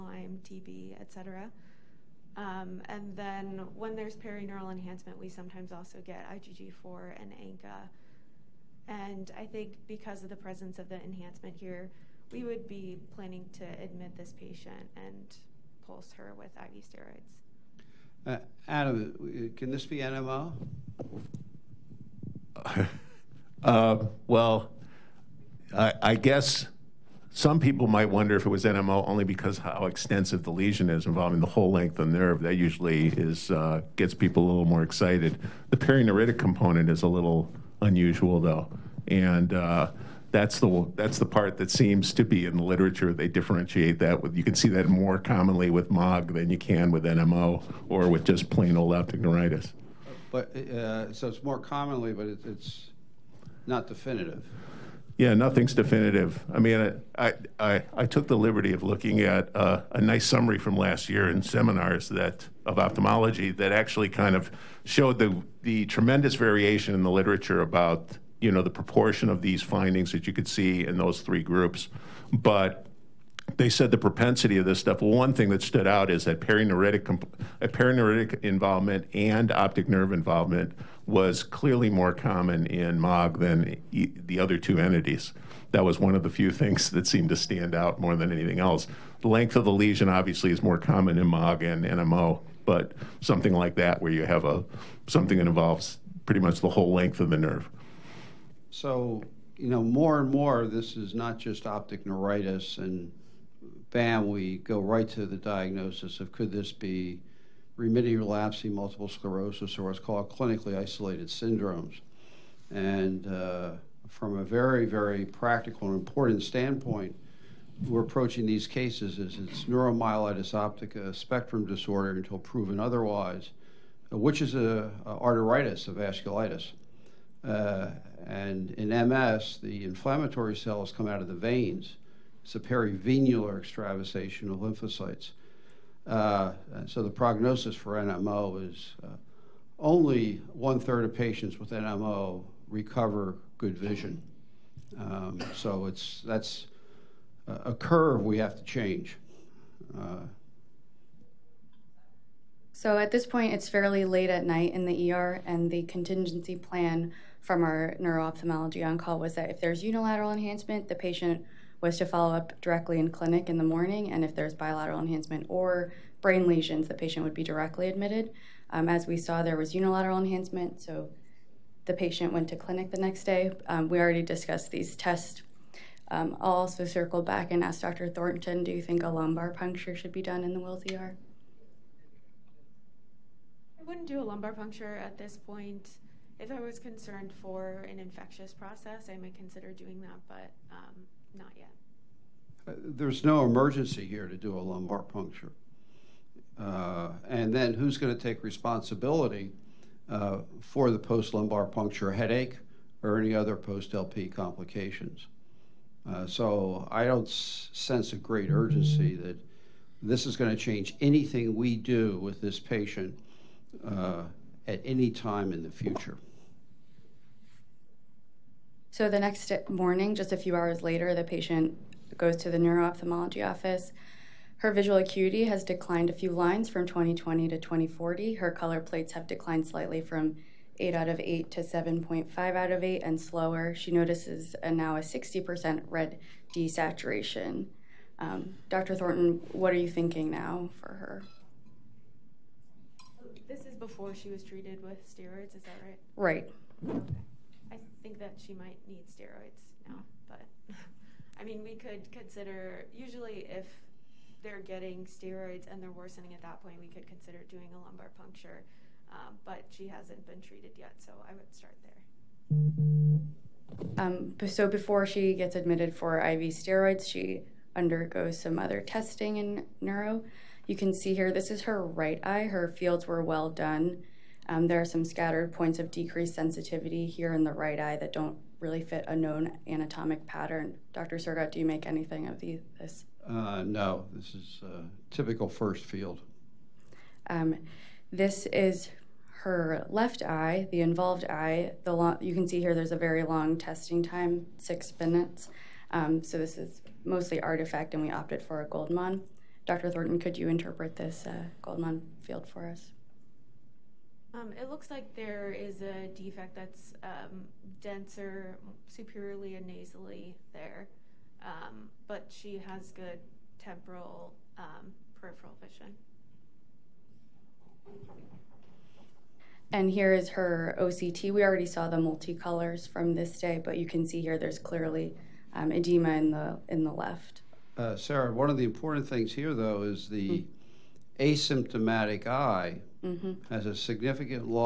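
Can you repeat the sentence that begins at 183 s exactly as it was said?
I wouldn't do a lumbar puncture at this point.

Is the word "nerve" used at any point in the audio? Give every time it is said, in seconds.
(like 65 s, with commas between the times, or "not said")
32 s, 79 s, 97 s.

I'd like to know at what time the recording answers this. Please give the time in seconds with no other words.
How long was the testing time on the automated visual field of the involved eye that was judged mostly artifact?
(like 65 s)
294 s.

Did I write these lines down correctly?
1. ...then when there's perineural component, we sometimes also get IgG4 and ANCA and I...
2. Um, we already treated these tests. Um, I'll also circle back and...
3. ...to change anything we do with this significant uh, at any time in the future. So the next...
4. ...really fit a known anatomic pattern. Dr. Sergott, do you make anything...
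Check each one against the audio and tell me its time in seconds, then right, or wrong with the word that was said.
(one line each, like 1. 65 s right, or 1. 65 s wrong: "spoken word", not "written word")
1. 3 s wrong: "enhancement", not "component"
2. 173 s wrong: "discussed", not "treated"
3. 210 s wrong: "patient", not "significant"
4. 278 s right.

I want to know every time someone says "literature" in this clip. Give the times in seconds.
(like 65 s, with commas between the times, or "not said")
42 s, 67 s.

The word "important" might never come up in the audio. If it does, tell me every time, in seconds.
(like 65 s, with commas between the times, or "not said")
115 s, 328 s.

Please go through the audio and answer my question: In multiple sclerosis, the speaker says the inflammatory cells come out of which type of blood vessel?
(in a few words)
Veins.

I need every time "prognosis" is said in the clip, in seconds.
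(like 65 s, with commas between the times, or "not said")
137 s.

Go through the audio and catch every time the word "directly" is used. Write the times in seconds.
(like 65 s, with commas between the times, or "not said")
162 s, 167 s.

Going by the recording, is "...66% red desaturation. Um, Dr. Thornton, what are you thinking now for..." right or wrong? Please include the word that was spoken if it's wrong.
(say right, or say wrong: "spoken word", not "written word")
wrong: "60", not "66".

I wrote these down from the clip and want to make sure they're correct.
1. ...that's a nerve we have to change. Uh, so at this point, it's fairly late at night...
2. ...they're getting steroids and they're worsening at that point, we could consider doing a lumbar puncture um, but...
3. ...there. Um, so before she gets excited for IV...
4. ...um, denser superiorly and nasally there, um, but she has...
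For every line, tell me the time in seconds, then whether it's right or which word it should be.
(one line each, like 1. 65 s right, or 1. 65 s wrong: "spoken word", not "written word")
1. 146 s wrong: "curve", not "nerve"
2. 254 s right
3. 262 s wrong: "admitted", not "excited"
4. 307 s right.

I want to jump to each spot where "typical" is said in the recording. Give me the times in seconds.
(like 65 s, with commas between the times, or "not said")
285 s.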